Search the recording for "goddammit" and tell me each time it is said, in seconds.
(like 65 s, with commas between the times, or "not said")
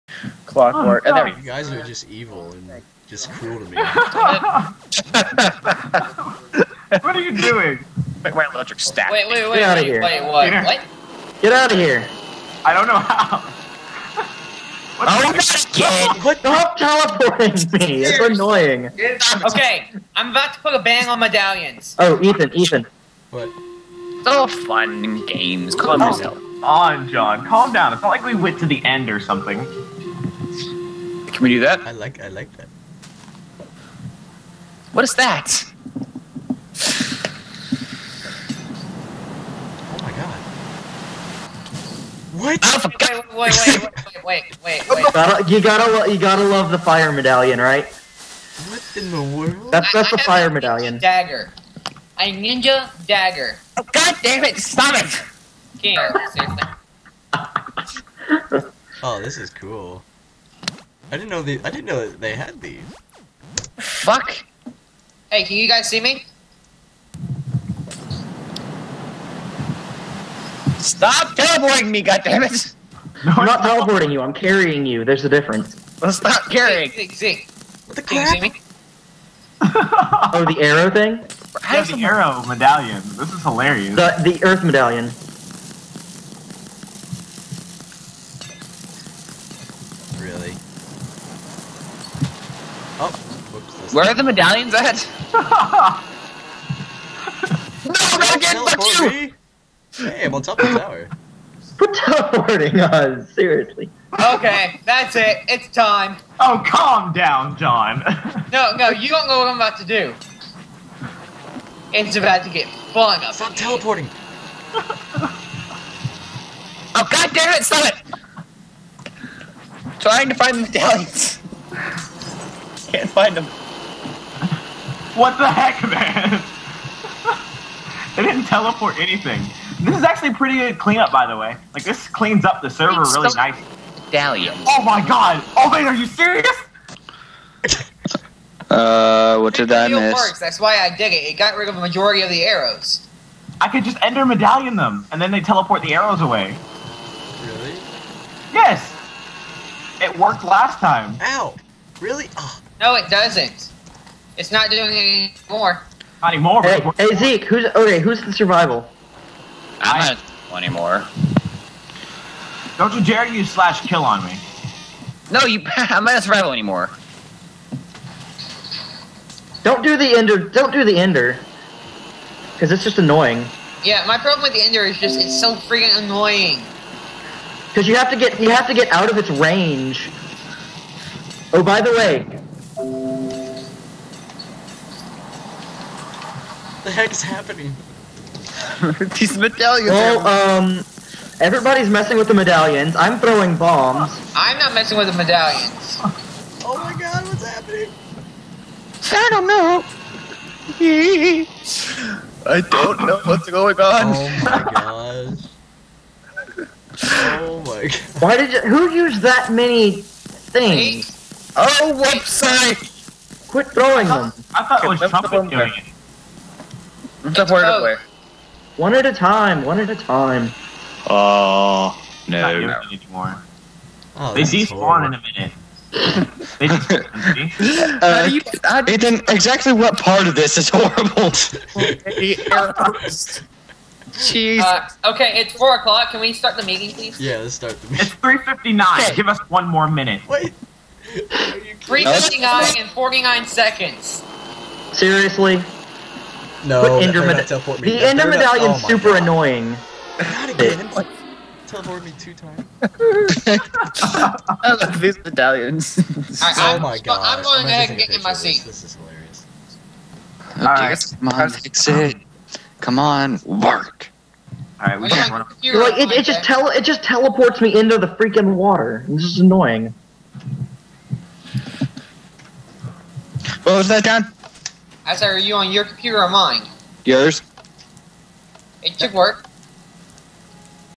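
72 s.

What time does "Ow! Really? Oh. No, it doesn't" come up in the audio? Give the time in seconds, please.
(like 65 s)
151 s.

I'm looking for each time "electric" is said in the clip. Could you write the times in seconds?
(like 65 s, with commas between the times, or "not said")
8 s.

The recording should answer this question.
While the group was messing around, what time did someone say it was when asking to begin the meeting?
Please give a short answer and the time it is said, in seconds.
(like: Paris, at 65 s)
4 o'clock, at 235 s.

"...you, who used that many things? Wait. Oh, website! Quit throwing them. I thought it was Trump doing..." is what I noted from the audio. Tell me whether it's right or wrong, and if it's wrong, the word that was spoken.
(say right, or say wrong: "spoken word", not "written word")
right.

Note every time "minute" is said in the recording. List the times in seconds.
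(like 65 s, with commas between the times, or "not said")
225 s, 239 s.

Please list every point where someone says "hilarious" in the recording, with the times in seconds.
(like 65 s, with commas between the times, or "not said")
83 s, 258 s.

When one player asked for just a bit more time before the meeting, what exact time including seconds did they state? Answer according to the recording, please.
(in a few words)
3:59:49.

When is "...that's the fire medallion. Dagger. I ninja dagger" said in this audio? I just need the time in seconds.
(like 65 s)
49 s.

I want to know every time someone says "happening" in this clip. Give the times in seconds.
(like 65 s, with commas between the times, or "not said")
187 s, 197 s.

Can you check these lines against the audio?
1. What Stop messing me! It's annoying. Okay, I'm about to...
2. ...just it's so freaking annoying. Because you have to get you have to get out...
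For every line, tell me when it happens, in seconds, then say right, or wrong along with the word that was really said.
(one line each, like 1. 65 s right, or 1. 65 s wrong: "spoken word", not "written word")
1. 16 s wrong: "teleporting", not "messing"
2. 174 s right.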